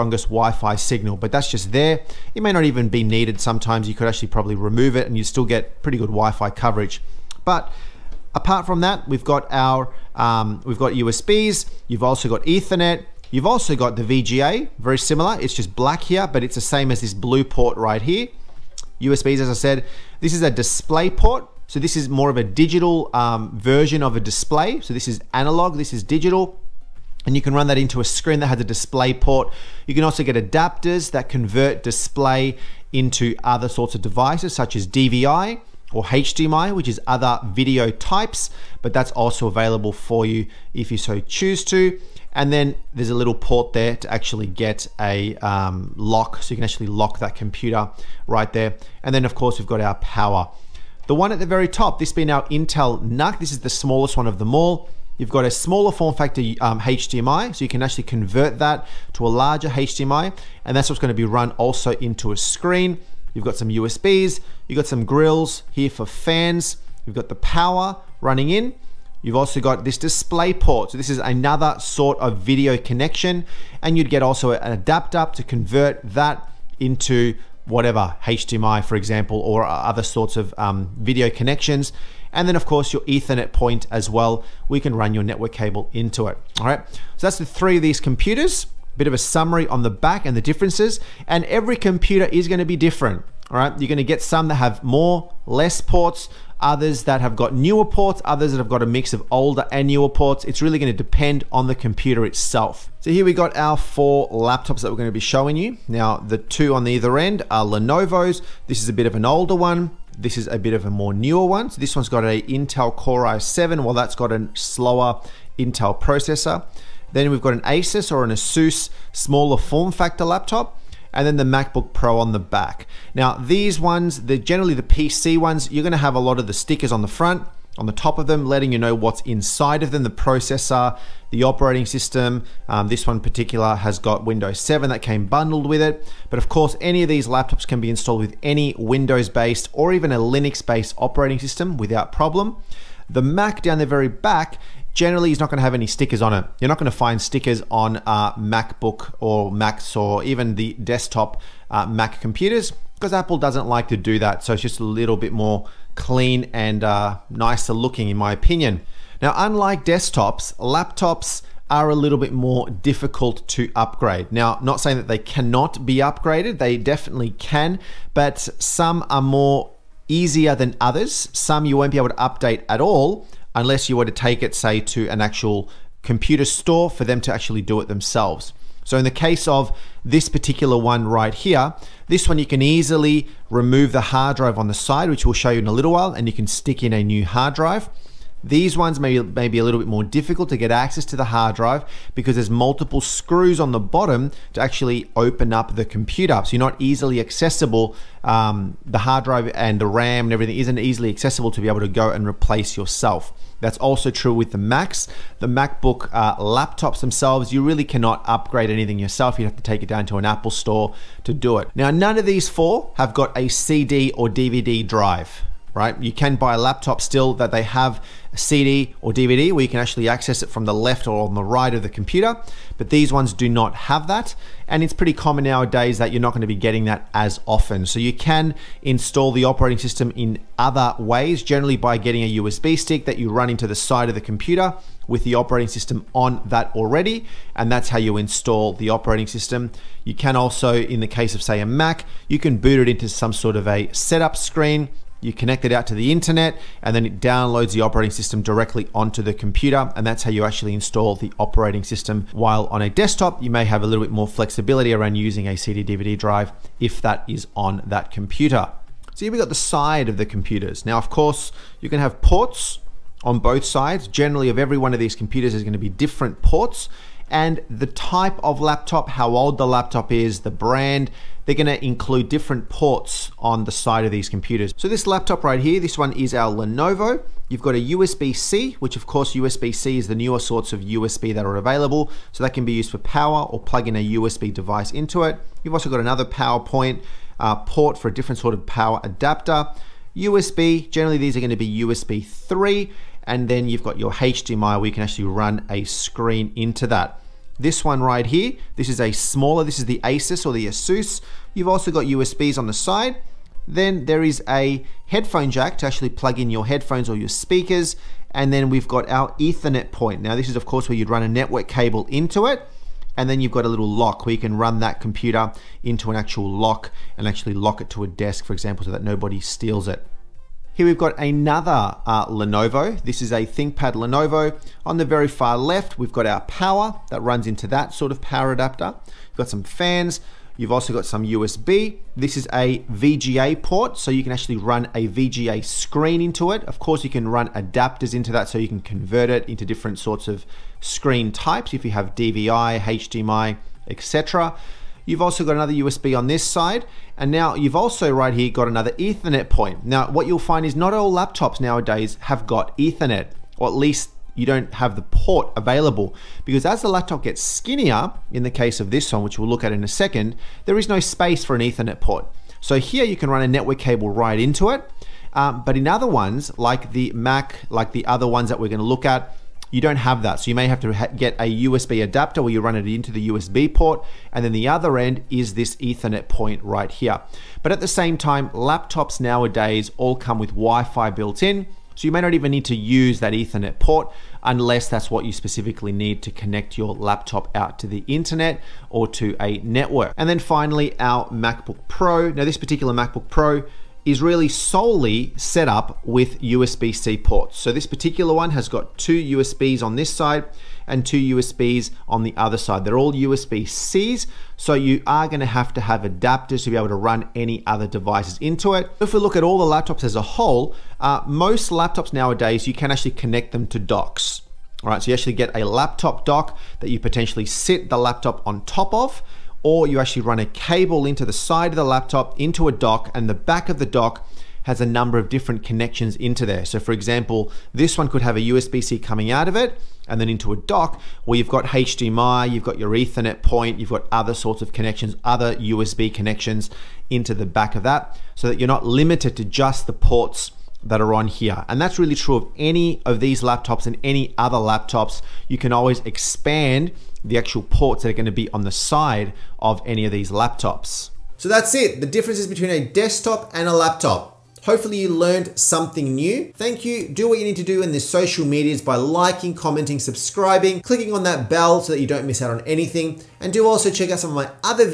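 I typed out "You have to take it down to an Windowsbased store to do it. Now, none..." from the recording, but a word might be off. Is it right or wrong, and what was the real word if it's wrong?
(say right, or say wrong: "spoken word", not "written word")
wrong: "Apple", not "Windowsbased".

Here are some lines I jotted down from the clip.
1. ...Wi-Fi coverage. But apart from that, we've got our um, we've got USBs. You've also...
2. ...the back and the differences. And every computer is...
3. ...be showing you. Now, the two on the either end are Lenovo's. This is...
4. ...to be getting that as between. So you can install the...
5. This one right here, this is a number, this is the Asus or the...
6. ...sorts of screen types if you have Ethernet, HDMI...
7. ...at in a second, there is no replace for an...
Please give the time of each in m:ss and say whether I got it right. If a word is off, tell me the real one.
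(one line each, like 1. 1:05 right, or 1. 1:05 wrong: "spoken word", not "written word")
1. 0:06 right
2. 1:29 right
3. 1:45 right
4. 3:46 wrong: "often", not "between"
5. 4:57 wrong: "smaller", not "number"
6. 5:39 wrong: "DVI", not "Ethernet"
7. 5:59 wrong: "space", not "replace".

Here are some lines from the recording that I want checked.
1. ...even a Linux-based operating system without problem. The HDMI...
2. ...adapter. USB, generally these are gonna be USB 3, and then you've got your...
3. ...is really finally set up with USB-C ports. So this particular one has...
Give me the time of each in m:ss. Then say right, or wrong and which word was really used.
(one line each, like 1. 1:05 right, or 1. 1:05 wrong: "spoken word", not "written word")
1. 2:19 wrong: "Mac", not "HDMI"
2. 4:49 right
3. 6:34 wrong: "solely", not "finally".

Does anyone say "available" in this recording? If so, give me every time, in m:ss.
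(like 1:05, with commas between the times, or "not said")
0:39, 4:41, 5:55.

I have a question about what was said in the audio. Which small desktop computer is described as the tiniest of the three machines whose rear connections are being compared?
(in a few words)
Intel NUC.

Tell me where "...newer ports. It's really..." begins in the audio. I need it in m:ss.
1:39.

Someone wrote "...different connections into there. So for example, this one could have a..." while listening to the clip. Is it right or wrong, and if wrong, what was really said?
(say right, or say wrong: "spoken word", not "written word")
right.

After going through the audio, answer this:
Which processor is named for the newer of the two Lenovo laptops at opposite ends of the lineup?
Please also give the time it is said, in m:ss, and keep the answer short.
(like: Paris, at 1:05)
Intel Core i7, at 1:52.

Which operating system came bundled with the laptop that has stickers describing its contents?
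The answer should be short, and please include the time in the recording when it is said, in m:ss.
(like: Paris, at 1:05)
Windows 7, at 2:14.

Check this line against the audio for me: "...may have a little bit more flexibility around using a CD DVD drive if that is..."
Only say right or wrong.
right.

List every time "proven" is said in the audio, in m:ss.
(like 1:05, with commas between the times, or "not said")
not said.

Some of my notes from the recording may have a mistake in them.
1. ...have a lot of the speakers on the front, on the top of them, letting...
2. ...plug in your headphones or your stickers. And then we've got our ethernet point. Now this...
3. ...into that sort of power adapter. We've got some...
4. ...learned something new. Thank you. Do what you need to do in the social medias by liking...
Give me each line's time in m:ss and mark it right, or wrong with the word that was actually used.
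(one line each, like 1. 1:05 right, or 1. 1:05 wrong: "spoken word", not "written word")
1. 2:05 wrong: "stickers", not "speakers"
2. 5:06 wrong: "speakers", not "stickers"
3. 5:27 right
4. 7:35 right.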